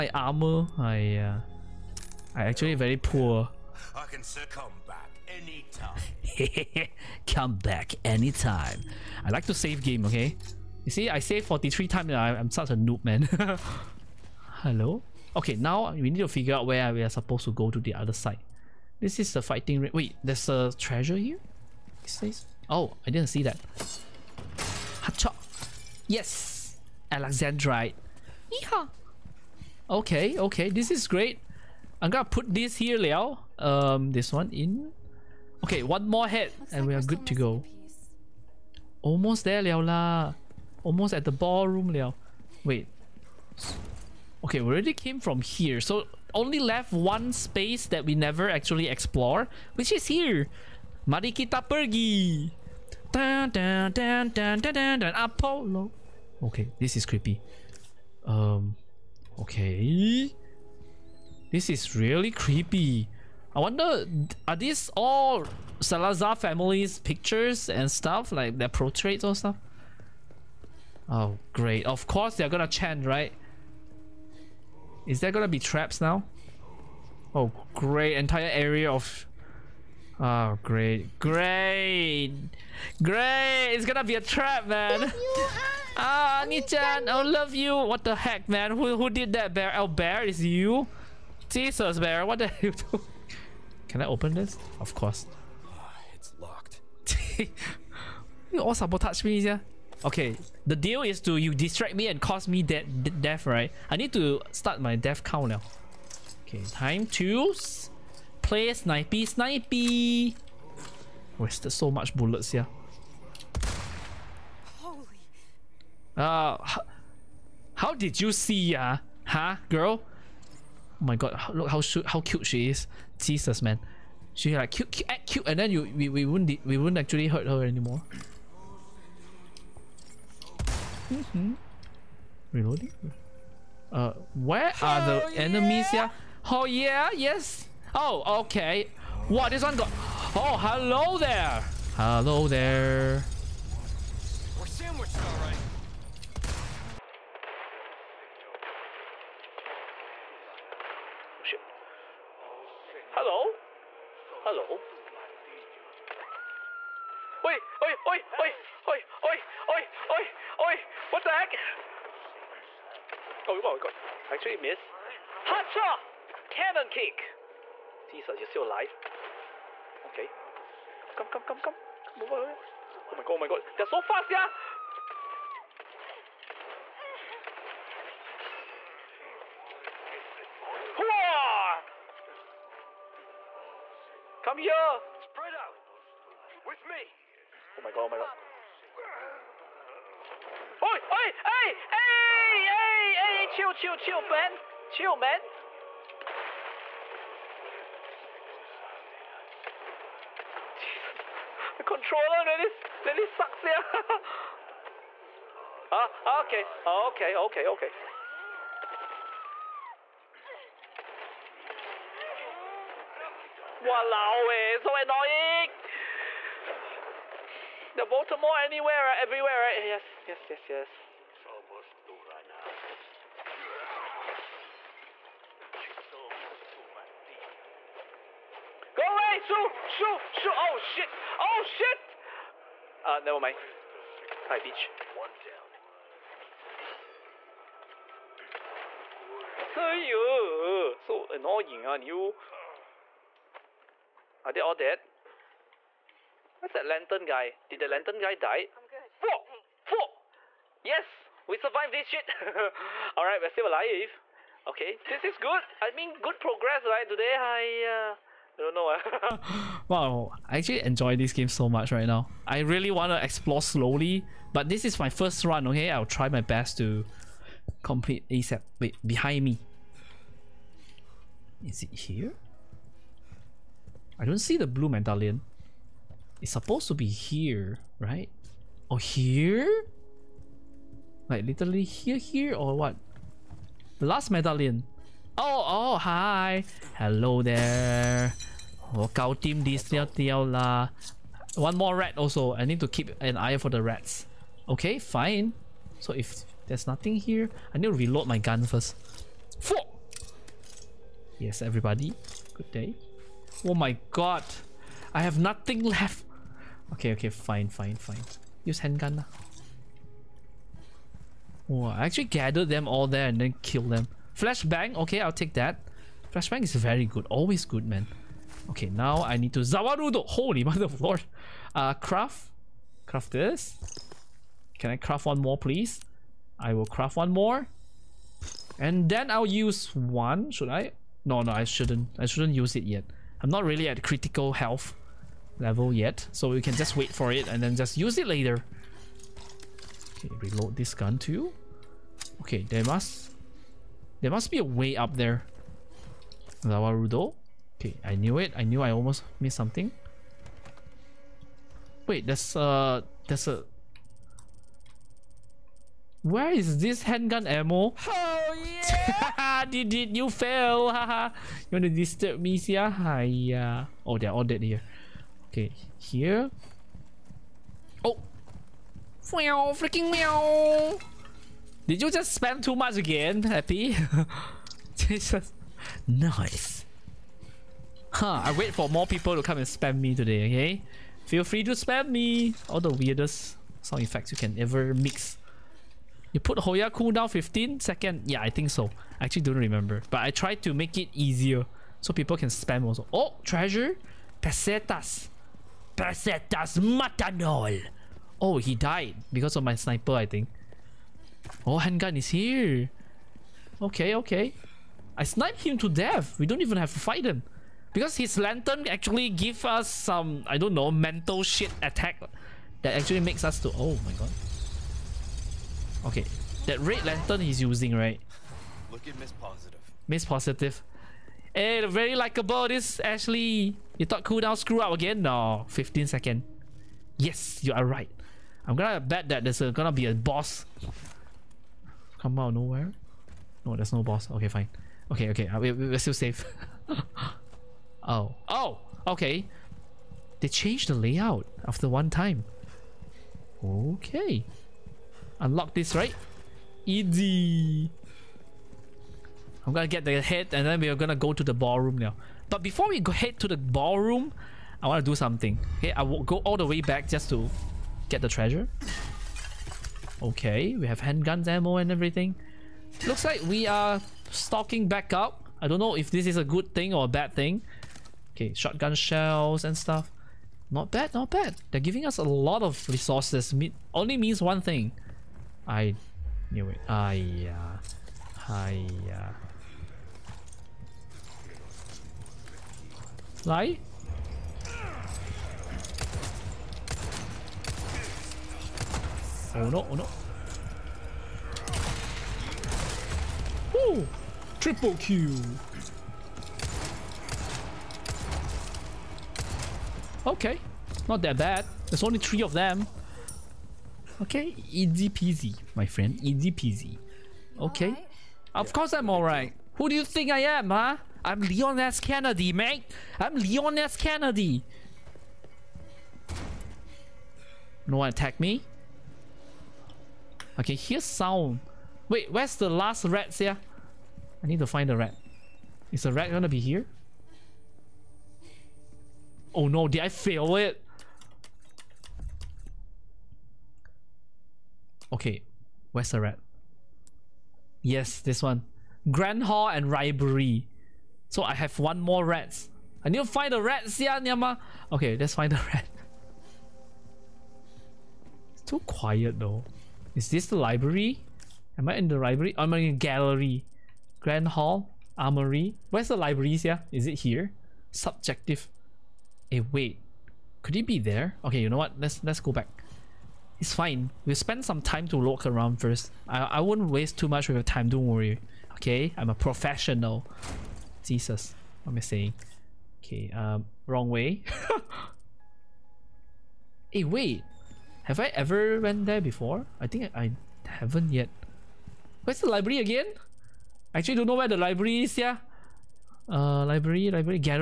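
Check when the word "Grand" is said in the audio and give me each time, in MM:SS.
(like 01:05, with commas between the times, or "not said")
08:59, 09:14.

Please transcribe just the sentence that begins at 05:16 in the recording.
Flashbang is very good, always good, man.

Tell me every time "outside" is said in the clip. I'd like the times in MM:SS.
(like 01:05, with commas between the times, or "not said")
not said.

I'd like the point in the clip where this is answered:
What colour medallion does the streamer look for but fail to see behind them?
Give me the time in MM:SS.
04:34.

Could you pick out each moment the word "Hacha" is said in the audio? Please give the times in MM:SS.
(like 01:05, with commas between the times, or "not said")
00:25, 02:45.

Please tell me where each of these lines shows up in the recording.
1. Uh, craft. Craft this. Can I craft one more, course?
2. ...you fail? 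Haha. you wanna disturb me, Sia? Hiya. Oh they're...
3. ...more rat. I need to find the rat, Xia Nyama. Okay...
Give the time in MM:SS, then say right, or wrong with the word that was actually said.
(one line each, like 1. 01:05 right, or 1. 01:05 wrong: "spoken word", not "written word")
1. 05:21 wrong: "please", not "course"
2. 06:00 right
3. 09:01 right.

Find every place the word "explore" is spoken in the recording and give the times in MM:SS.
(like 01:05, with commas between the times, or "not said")
00:48, 04:23.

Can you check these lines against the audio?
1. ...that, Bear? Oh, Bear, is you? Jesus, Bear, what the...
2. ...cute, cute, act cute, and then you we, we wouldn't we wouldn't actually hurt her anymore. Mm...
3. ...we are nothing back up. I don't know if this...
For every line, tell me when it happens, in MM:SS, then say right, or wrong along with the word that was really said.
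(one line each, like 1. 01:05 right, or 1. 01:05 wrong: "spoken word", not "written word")
1. 01:29 right
2. 02:04 right
3. 07:43 wrong: "stalking", not "nothing".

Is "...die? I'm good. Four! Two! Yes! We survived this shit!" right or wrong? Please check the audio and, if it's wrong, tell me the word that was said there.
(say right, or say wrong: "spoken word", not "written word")
wrong: "Four", not "Two".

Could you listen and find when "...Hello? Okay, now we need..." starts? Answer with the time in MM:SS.
00:14.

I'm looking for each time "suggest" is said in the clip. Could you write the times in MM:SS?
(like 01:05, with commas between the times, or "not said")
not said.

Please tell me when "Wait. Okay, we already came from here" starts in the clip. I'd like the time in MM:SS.
00:42.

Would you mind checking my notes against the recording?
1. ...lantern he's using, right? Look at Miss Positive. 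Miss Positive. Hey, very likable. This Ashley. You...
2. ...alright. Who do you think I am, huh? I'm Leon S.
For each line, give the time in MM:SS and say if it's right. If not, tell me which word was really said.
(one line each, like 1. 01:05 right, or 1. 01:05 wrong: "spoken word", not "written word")
1. 06:57 right
2. 08:29 right.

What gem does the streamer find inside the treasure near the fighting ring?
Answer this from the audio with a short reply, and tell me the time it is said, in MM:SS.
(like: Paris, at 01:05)
Alexandrite, at 00:27.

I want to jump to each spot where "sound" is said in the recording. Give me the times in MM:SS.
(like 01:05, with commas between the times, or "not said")
06:23, 08:41.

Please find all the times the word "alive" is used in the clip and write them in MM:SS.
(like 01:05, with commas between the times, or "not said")
02:48, 04:13.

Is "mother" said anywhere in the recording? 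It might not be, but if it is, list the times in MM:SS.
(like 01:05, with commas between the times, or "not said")
05:20.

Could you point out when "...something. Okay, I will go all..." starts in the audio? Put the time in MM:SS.
07:35.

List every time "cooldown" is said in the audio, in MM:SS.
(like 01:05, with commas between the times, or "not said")
06:26, 07:04.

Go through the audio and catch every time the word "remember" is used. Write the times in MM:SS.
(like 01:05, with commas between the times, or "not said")
06:29.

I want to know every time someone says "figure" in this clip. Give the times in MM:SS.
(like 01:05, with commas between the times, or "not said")
00:16.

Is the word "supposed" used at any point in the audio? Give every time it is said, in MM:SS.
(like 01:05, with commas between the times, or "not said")
00:17, 04:36.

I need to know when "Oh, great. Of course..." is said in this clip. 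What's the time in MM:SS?
01:11.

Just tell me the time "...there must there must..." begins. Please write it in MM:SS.
05:42.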